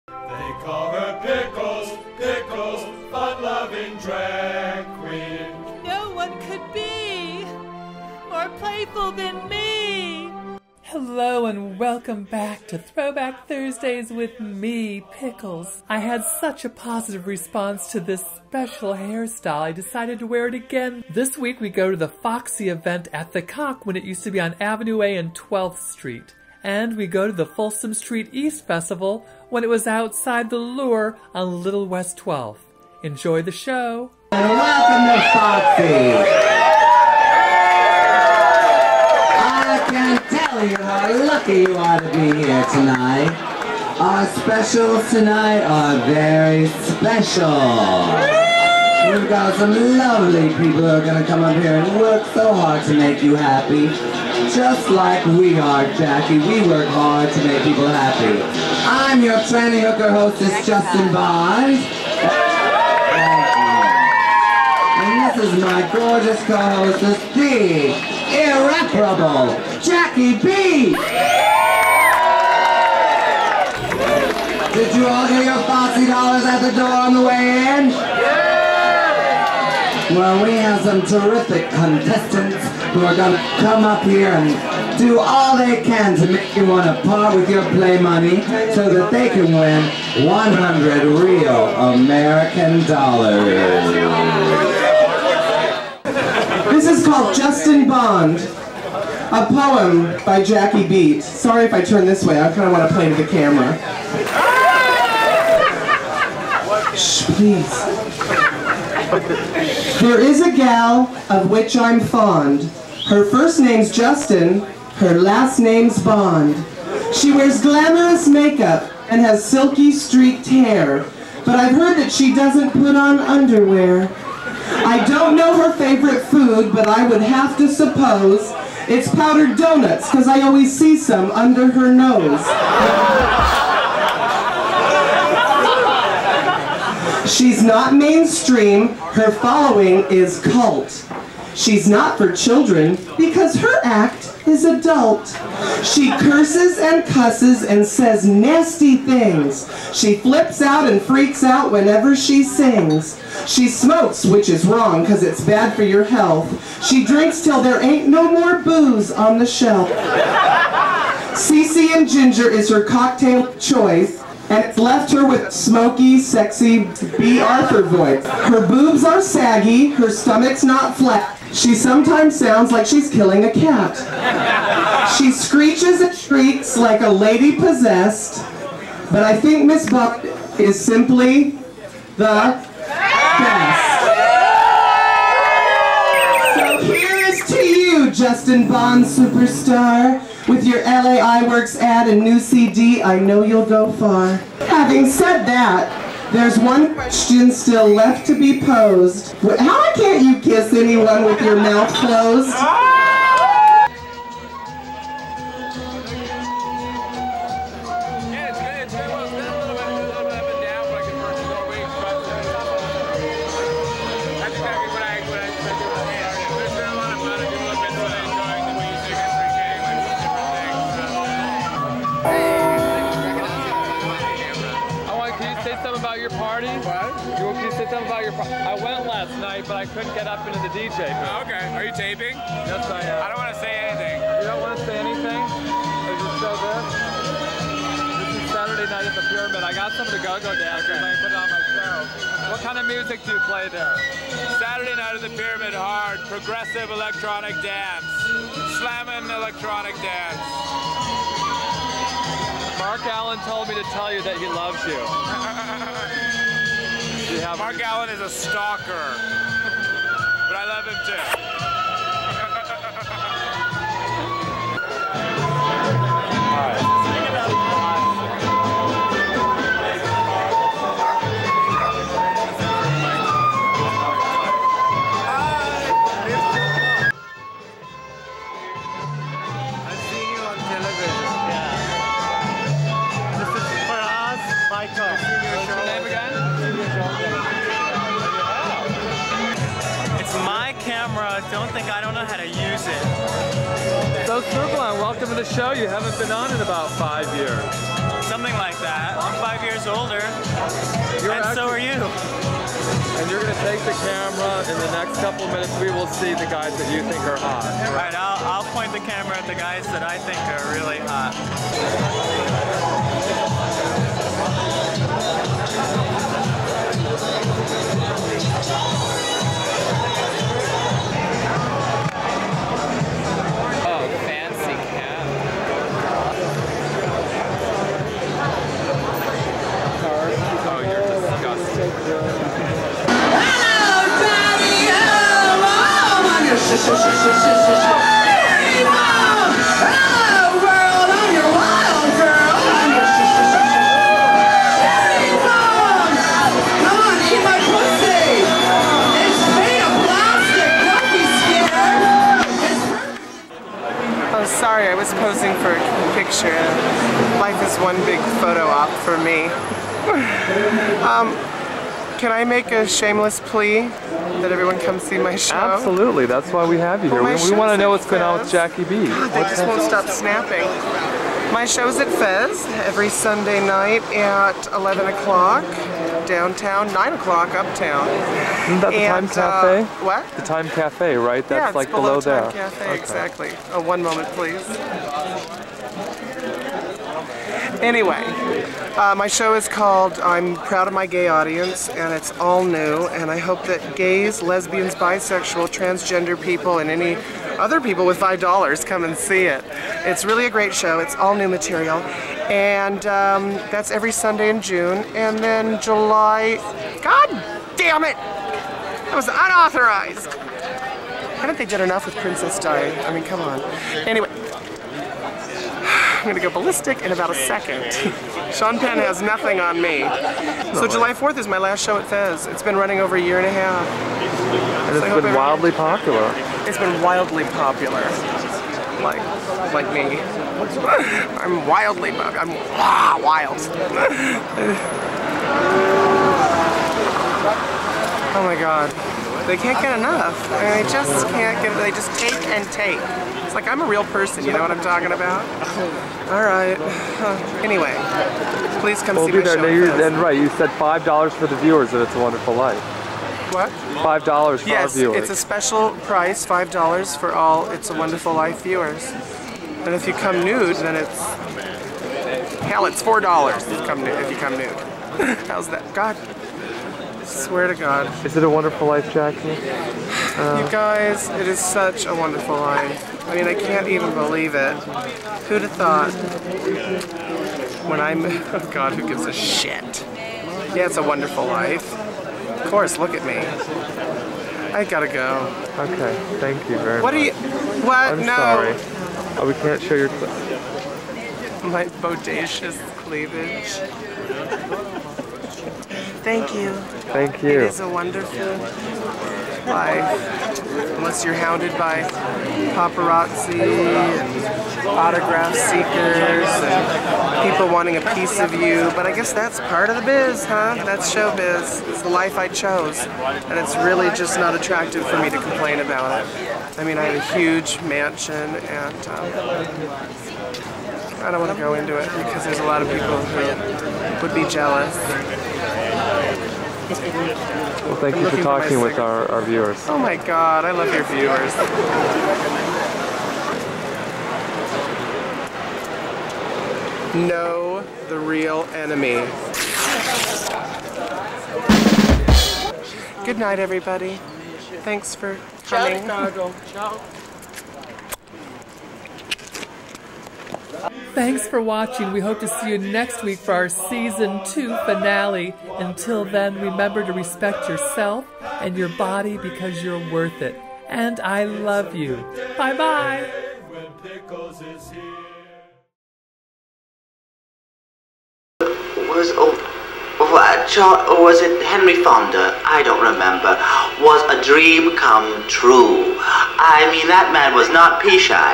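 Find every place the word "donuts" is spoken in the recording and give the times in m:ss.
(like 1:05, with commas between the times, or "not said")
2:09.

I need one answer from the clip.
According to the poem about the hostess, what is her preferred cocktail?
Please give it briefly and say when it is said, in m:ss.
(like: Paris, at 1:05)
CC and Ginger, at 2:41.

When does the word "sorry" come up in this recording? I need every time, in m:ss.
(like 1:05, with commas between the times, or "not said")
1:41, 8:08.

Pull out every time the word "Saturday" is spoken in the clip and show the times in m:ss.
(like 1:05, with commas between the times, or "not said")
3:58, 4:04.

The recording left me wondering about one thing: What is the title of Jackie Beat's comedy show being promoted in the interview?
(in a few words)
I'm Proud of My Gay Audience.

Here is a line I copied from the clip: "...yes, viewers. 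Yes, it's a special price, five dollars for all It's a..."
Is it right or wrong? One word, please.
right.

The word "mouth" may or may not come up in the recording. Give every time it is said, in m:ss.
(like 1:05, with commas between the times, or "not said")
3:21.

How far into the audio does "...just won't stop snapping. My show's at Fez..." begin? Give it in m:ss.
6:09.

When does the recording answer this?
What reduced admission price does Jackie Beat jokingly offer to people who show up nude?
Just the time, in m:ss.
7:43.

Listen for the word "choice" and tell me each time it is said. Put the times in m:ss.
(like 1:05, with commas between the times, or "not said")
2:43.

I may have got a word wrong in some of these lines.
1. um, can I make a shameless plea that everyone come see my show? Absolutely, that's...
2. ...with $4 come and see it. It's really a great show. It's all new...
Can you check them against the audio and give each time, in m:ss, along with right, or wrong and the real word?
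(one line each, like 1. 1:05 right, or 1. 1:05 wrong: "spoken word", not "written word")
1. 6:01 right
2. 6:38 wrong: "5", not "4".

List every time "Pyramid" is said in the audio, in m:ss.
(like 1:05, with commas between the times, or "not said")
3:59, 4:05.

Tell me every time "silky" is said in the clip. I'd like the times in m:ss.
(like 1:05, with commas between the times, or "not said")
1:59.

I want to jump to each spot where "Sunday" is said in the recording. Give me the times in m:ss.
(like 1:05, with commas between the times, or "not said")
6:13, 6:44.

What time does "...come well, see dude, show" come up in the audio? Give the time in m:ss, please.
7:29.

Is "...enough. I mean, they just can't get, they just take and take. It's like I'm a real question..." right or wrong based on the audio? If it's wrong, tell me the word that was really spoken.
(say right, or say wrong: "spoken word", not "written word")
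wrong: "person", not "question".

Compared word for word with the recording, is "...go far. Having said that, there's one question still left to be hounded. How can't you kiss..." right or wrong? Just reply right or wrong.
wrong.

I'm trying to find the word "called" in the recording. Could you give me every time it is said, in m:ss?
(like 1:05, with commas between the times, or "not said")
1:37, 6:29.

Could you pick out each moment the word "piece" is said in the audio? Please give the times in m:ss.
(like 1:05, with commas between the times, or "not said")
8:28.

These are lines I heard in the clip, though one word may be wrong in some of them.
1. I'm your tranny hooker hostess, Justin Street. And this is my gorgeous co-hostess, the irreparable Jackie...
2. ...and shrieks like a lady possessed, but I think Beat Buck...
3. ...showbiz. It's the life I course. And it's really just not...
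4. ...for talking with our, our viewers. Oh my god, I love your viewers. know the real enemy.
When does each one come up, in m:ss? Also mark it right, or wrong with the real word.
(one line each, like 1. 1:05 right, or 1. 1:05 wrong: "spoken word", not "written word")
1. 0:58 wrong: "Bond", not "Street"
2. 2:55 wrong: "Miss", not "Beat"
3. 8:31 wrong: "chose", not "course"
4. 8:48 right.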